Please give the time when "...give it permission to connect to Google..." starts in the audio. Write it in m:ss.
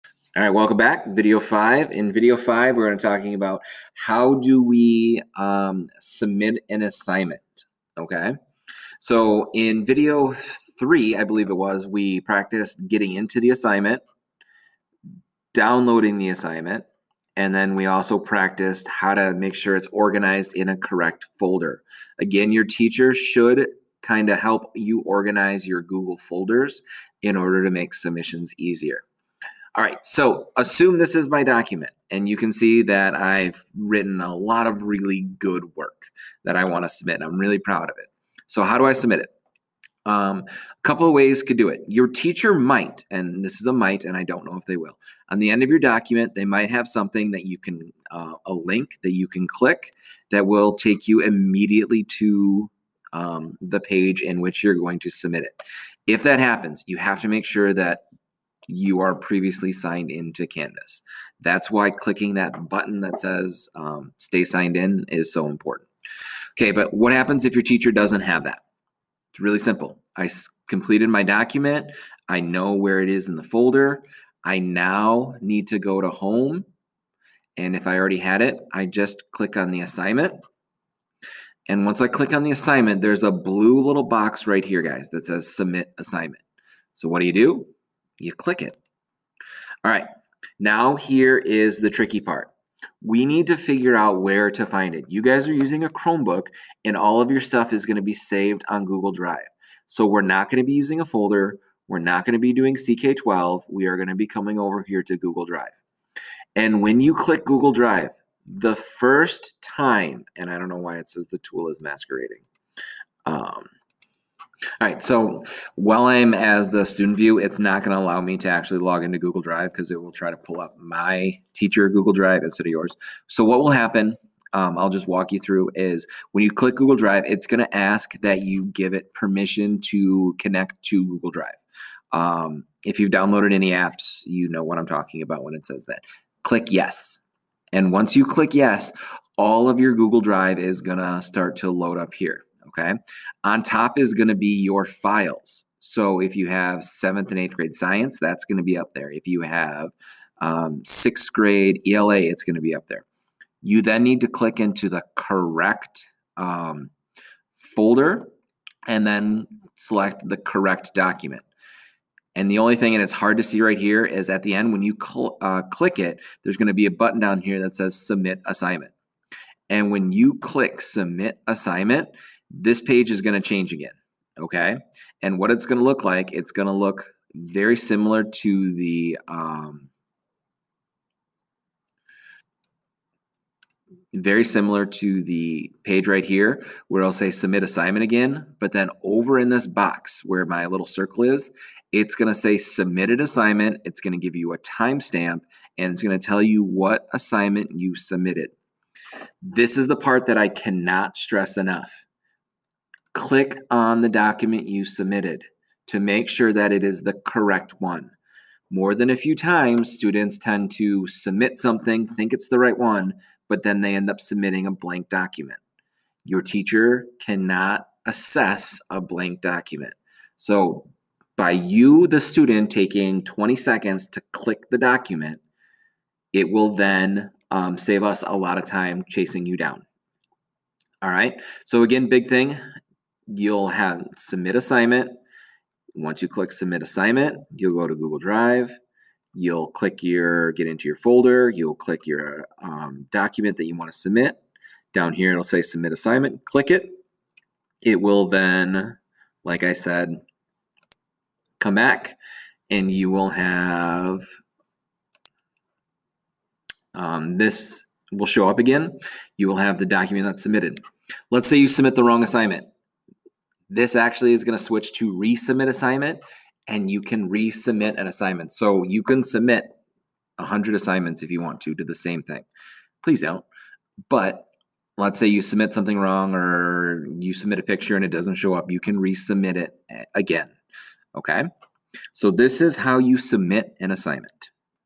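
2:08.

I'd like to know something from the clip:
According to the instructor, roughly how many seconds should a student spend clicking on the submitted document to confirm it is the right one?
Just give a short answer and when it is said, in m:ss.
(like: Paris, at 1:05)
20, at 3:43.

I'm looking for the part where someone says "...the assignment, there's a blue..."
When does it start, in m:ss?
1:22.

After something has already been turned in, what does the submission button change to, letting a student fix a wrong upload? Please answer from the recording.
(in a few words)
Resubmit assignment.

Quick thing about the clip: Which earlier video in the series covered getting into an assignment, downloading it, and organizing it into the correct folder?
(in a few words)
Video 3.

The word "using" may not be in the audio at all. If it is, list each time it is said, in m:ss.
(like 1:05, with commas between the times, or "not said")
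1:35, 1:40.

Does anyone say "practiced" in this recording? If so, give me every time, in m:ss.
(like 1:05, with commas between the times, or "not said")
0:12, 0:18.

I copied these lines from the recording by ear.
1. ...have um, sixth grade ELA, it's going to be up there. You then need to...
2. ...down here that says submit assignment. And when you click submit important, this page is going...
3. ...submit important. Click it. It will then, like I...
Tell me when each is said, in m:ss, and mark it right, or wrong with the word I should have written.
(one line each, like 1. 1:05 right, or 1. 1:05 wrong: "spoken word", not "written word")
1. 2:29 right
2. 2:47 wrong: "assignment", not "important"
3. 4:05 wrong: "assignment", not "important".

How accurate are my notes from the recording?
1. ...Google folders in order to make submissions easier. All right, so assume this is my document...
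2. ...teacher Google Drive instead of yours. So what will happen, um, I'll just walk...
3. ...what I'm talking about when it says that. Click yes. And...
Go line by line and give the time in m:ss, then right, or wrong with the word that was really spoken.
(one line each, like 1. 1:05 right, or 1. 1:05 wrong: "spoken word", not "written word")
1. 0:25 right
2. 2:01 right
3. 2:14 right.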